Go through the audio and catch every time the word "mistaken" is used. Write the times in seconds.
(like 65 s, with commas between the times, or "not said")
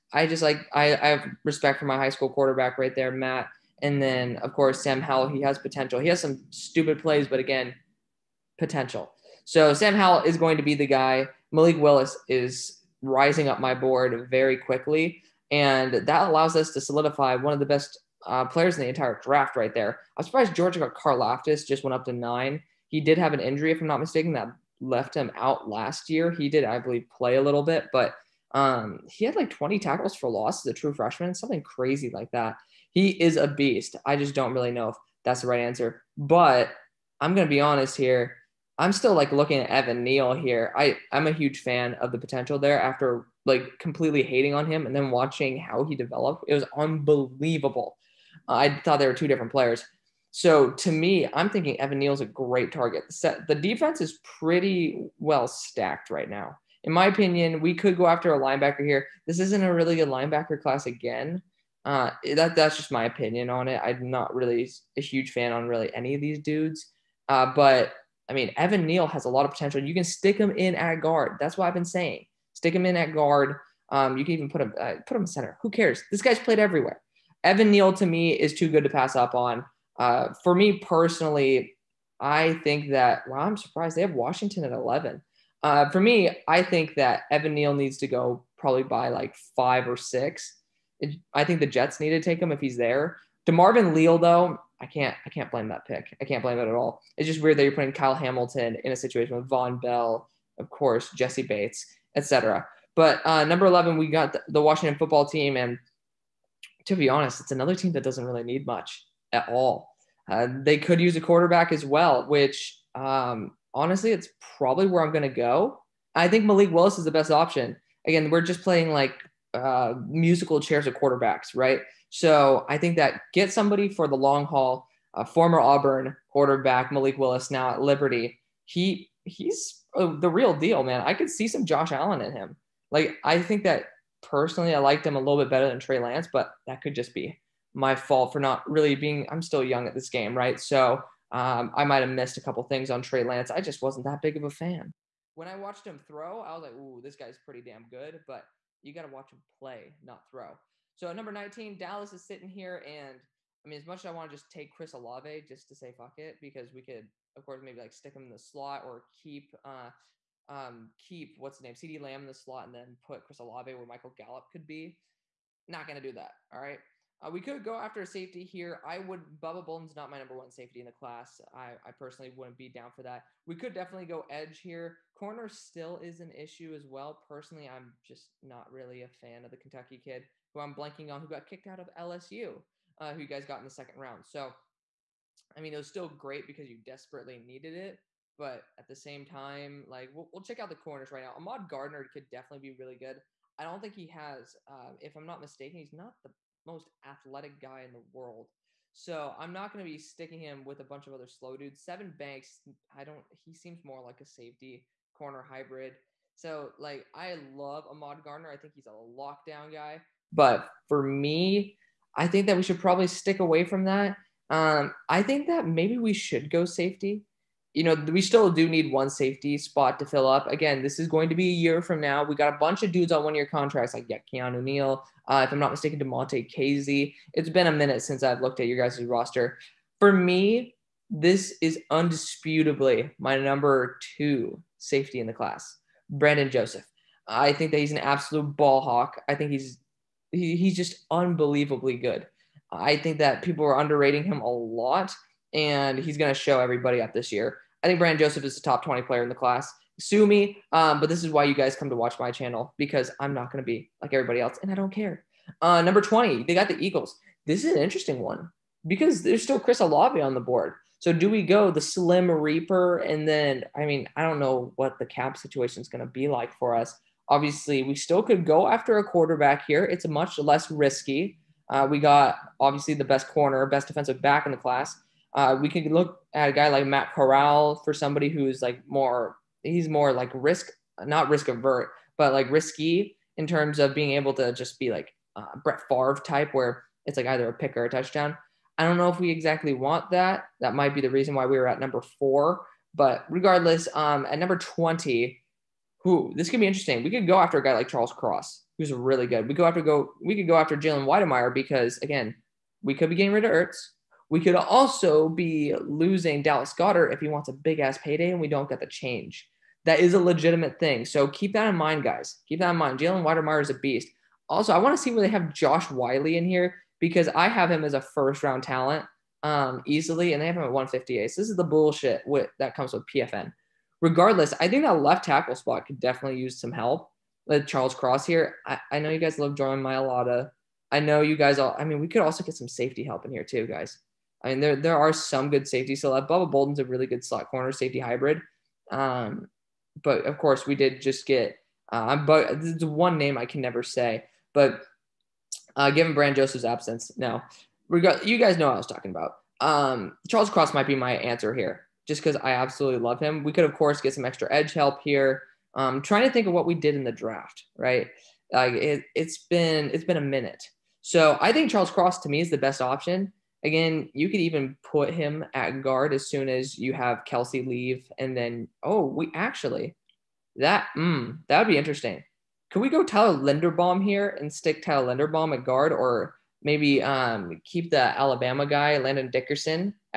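23 s, 195 s, 225 s.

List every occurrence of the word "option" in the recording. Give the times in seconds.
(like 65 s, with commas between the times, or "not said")
117 s, 362 s.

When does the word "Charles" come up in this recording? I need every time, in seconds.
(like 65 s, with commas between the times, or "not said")
297 s, 327 s, 350 s, 361 s.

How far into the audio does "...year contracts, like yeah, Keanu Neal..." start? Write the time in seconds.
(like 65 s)
223 s.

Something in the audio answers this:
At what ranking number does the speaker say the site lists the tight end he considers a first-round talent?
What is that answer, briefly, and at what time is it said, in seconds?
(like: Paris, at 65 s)
158, at 320 s.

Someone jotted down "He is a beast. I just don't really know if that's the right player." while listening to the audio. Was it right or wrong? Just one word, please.
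wrong.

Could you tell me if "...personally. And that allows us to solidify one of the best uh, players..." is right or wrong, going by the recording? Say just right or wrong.
wrong.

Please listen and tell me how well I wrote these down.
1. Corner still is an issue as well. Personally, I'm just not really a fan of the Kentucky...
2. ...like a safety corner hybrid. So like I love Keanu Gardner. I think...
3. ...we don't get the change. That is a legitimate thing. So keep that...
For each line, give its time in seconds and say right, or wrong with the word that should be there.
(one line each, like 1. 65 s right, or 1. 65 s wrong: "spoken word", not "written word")
1. 175 s right
2. 204 s wrong: "Ahmad", not "Keanu"
3. 308 s right.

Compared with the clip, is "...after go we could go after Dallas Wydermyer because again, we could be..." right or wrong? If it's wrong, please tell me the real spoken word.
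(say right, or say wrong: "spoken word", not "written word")
wrong: "Jalen", not "Dallas".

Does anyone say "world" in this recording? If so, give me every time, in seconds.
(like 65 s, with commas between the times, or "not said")
197 s.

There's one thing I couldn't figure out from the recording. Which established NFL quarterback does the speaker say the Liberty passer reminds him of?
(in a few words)
Josh Allen.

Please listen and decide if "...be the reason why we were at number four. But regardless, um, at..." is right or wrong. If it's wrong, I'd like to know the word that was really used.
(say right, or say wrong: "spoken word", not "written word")
right.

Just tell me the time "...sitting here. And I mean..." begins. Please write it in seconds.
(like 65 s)
152 s.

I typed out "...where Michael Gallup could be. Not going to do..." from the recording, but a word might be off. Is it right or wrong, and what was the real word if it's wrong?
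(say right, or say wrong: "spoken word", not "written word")
right.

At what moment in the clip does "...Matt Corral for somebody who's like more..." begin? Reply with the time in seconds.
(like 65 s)
276 s.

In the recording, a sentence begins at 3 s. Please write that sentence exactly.
And then of course Sam Howell, he has potential.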